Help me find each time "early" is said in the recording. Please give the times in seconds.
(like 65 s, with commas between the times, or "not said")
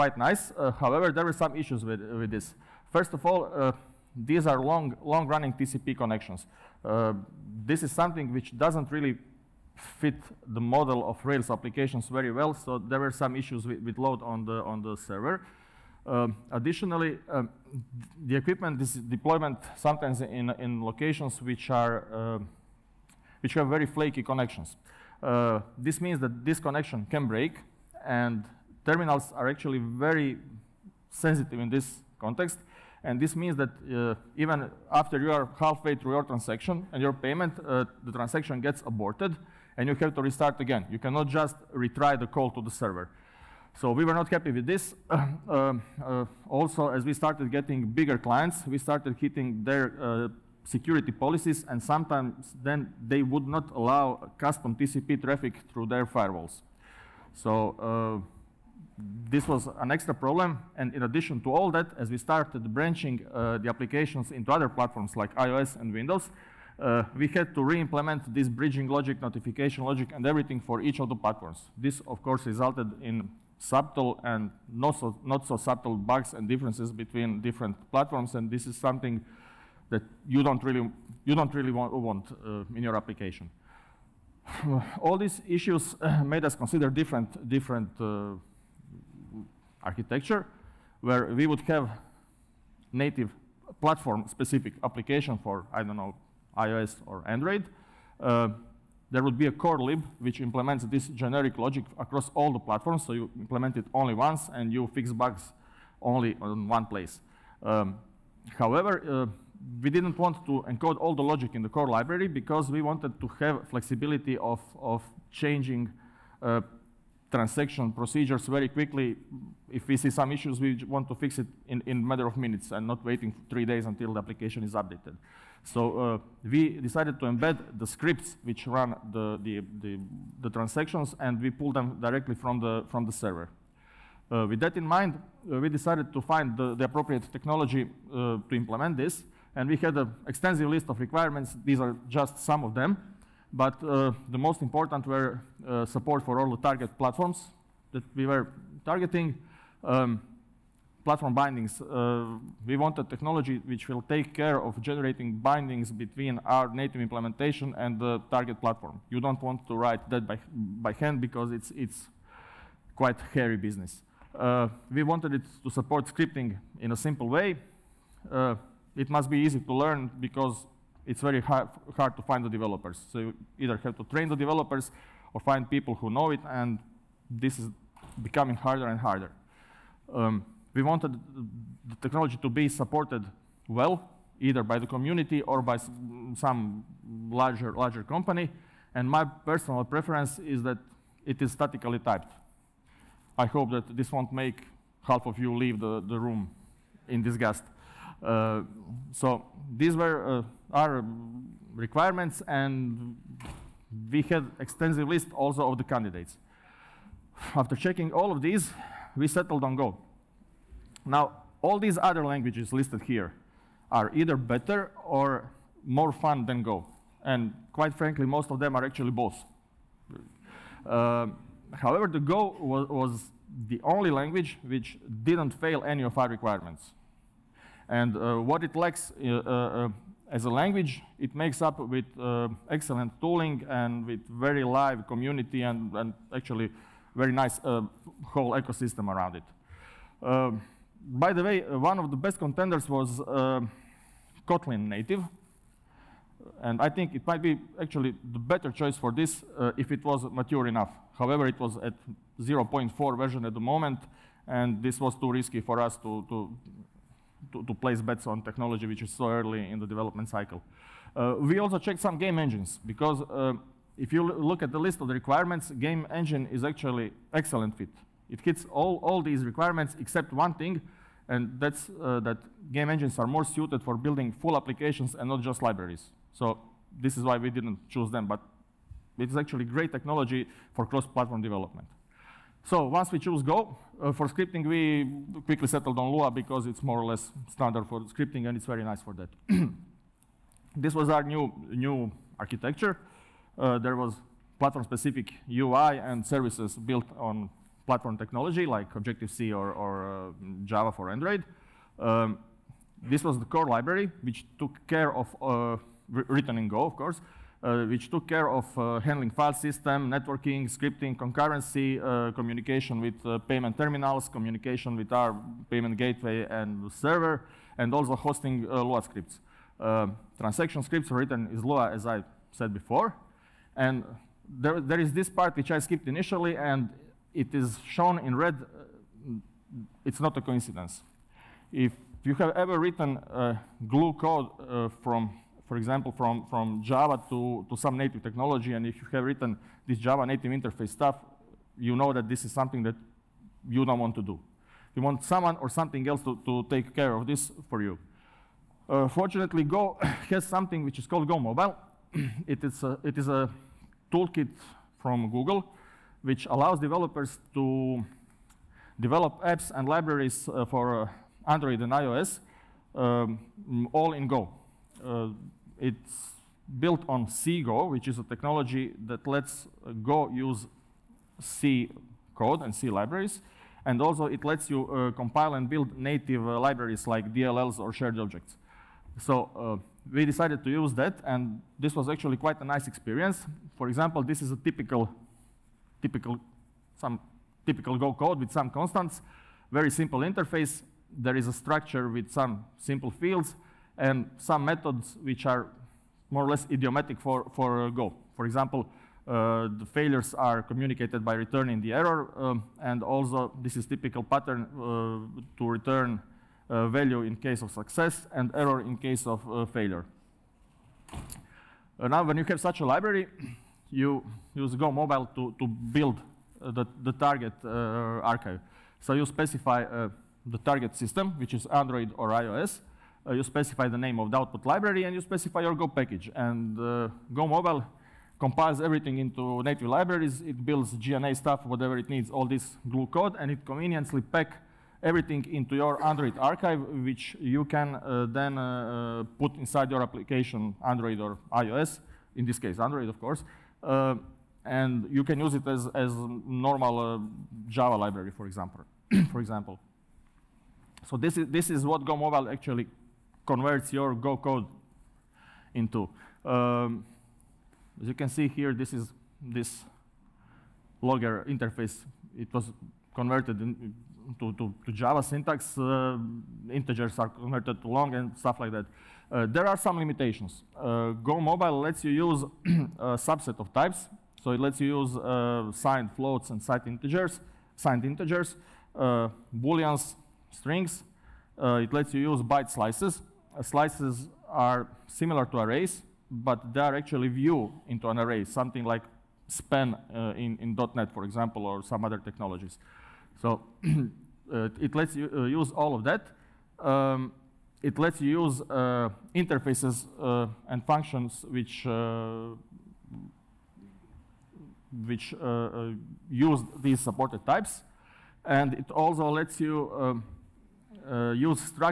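259 s.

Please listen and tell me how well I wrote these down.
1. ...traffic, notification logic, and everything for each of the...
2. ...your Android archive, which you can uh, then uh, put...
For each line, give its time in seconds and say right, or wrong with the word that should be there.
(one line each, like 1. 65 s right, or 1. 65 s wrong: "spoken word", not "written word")
1. 68 s wrong: "logic", not "traffic"
2. 435 s right.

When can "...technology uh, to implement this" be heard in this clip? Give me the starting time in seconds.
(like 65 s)
137 s.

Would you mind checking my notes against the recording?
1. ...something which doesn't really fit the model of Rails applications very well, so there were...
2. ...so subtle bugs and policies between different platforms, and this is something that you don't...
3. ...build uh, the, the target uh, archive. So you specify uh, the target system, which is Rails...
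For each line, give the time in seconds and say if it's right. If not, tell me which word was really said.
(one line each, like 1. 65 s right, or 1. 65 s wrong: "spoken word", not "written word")
1. 7 s right
2. 75 s wrong: "differences", not "policies"
3. 415 s wrong: "Android", not "Rails".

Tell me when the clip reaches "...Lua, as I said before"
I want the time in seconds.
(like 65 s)
321 s.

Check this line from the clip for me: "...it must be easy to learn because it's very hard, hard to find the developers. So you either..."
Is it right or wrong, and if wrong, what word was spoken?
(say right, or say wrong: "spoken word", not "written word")
right.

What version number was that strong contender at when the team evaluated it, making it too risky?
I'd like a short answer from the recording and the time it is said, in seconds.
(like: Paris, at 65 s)
0.4, at 252 s.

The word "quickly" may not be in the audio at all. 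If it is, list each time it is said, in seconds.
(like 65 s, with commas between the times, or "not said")
118 s, 285 s.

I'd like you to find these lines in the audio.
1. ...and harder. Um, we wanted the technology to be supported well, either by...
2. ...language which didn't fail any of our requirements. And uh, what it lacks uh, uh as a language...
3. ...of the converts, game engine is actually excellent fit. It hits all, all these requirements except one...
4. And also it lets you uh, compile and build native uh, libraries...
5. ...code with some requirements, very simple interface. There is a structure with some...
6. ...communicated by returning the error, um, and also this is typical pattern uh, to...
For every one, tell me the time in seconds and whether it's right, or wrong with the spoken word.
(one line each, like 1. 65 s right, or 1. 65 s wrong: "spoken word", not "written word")
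1. 178 s right
2. 224 s right
3. 265 s wrong: "requirements", not "converts"
4. 373 s right
5. 388 s wrong: "constants", not "requirements"
6. 400 s right.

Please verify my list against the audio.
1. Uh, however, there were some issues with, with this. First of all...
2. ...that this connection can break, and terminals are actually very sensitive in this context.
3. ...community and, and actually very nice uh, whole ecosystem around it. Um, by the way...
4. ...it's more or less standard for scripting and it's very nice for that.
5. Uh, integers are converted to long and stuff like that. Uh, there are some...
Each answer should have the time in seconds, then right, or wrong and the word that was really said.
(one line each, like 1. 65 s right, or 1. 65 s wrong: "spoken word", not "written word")
1. 0 s right
2. 26 s right
3. 235 s right
4. 286 s right
5. 465 s right.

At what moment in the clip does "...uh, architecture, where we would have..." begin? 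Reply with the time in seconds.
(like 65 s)
87 s.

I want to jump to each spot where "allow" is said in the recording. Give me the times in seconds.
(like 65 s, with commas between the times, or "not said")
53 s, 356 s.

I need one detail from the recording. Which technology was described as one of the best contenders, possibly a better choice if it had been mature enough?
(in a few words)
Kotlin native.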